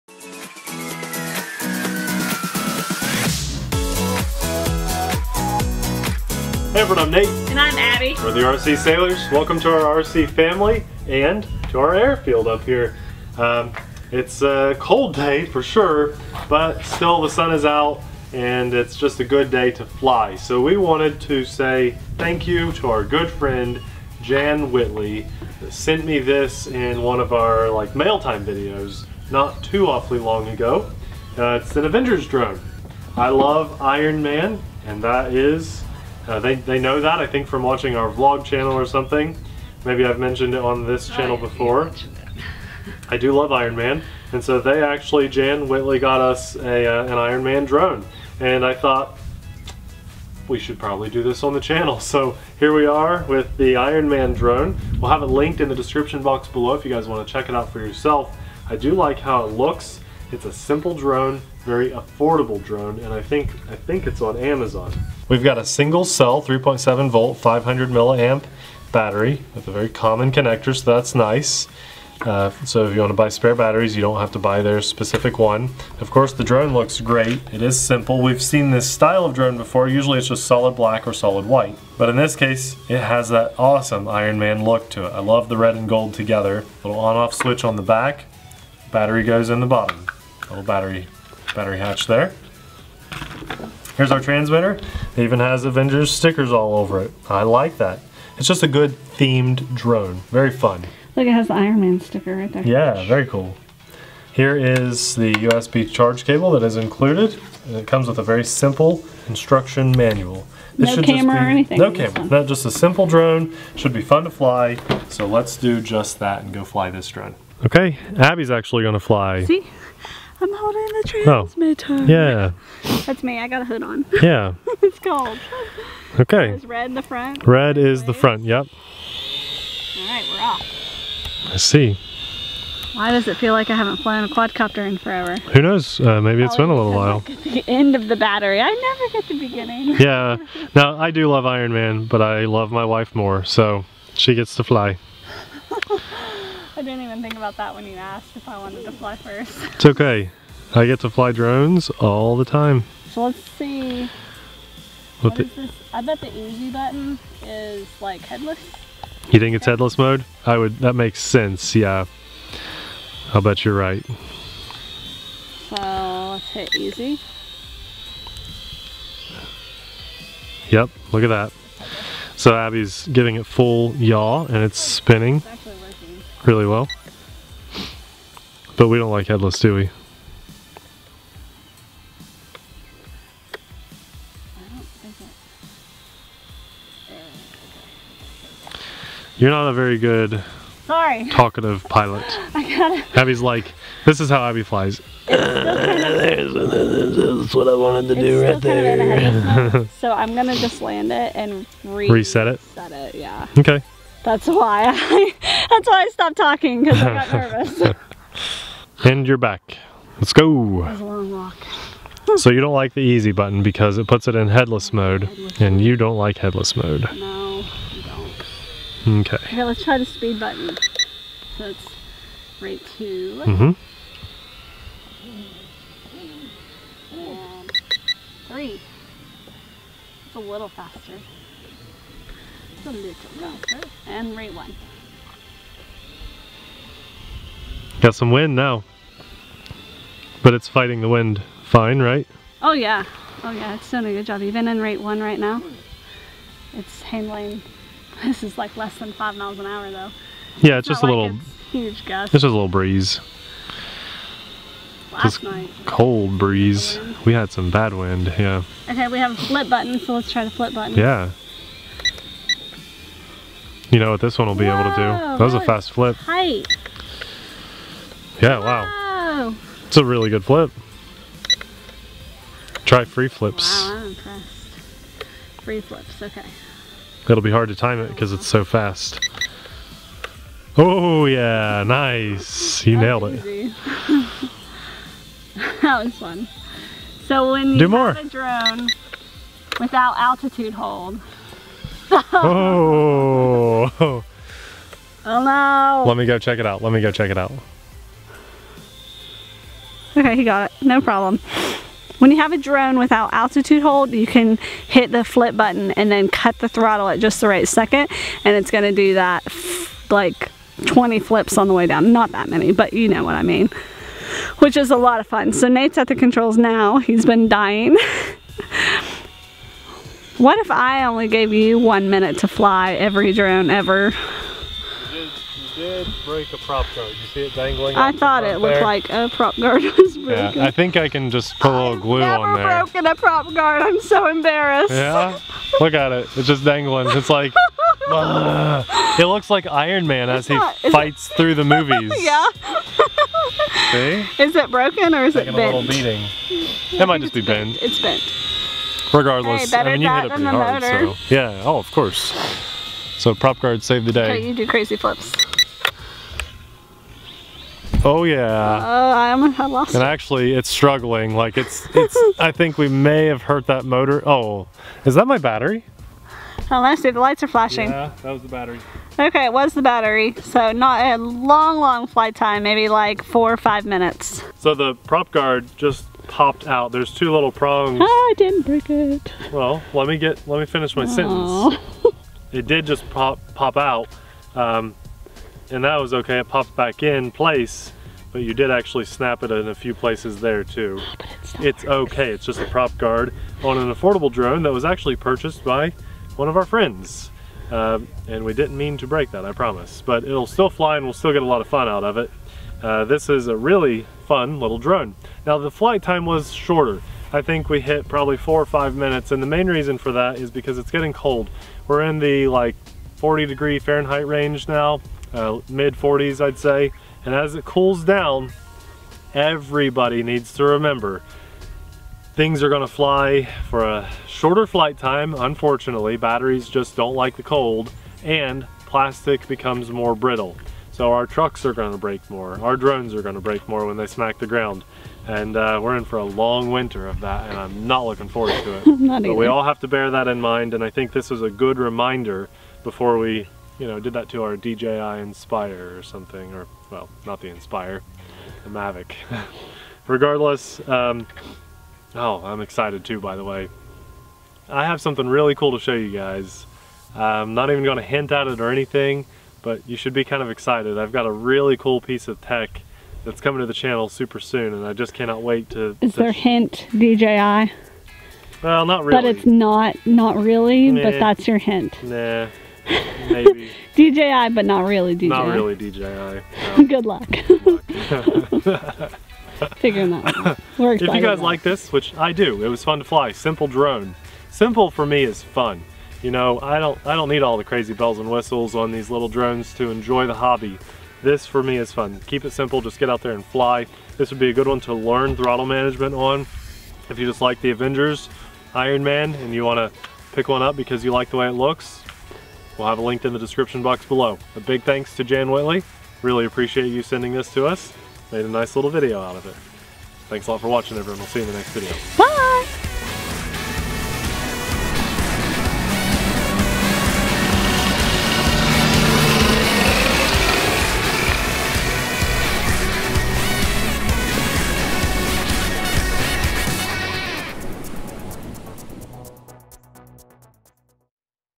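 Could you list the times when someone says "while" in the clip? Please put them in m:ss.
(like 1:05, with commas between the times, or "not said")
2:16.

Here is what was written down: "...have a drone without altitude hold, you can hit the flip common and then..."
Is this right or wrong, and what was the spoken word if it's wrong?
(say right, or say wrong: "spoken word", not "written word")
wrong: "button", not "common".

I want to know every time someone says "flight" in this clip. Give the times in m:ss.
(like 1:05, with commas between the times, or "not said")
6:12, 6:45, 7:04.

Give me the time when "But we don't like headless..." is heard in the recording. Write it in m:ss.
2:58.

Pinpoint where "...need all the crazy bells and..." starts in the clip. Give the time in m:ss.
8:07.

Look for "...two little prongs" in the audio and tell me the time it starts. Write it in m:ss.
6:17.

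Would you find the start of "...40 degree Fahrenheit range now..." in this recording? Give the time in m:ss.
6:53.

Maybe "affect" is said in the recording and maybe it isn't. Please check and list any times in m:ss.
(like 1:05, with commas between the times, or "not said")
not said.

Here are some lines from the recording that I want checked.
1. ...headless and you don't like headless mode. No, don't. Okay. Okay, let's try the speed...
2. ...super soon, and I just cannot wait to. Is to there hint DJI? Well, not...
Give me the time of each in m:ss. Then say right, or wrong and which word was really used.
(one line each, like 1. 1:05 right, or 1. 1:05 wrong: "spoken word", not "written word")
1. 3:35 right
2. 7:44 right.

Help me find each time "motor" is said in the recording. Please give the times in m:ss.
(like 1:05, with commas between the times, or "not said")
6:03.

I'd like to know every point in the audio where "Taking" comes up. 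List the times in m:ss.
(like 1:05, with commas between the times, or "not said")
5:45.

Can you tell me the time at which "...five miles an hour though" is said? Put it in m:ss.
4:09.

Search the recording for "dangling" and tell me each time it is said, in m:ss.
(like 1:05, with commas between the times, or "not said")
5:27, 5:36.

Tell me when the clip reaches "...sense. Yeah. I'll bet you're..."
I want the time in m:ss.
2:41.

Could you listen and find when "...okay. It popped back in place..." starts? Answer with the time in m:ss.
6:26.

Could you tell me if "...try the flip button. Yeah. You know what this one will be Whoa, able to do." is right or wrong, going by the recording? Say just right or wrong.
right.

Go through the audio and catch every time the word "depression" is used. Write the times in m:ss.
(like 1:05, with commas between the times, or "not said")
not said.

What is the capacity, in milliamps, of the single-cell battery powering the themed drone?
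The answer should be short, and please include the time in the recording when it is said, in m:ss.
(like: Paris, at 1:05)
500, at 1:07.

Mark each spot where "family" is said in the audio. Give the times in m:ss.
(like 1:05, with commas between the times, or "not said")
0:10.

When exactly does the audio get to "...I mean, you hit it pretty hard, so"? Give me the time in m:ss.
5:49.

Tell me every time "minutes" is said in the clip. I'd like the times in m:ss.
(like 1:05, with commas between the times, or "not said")
5:22, 6:13, 6:48.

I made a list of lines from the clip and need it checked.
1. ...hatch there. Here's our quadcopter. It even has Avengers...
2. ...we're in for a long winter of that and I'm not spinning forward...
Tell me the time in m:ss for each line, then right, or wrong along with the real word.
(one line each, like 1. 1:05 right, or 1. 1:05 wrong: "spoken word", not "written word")
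1. 1:31 wrong: "transmitter", not "quadcopter"
2. 7:15 wrong: "looking", not "spinning".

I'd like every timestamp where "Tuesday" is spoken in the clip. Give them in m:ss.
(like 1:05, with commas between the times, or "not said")
not said.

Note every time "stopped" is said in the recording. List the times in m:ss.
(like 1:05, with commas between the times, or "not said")
3:26.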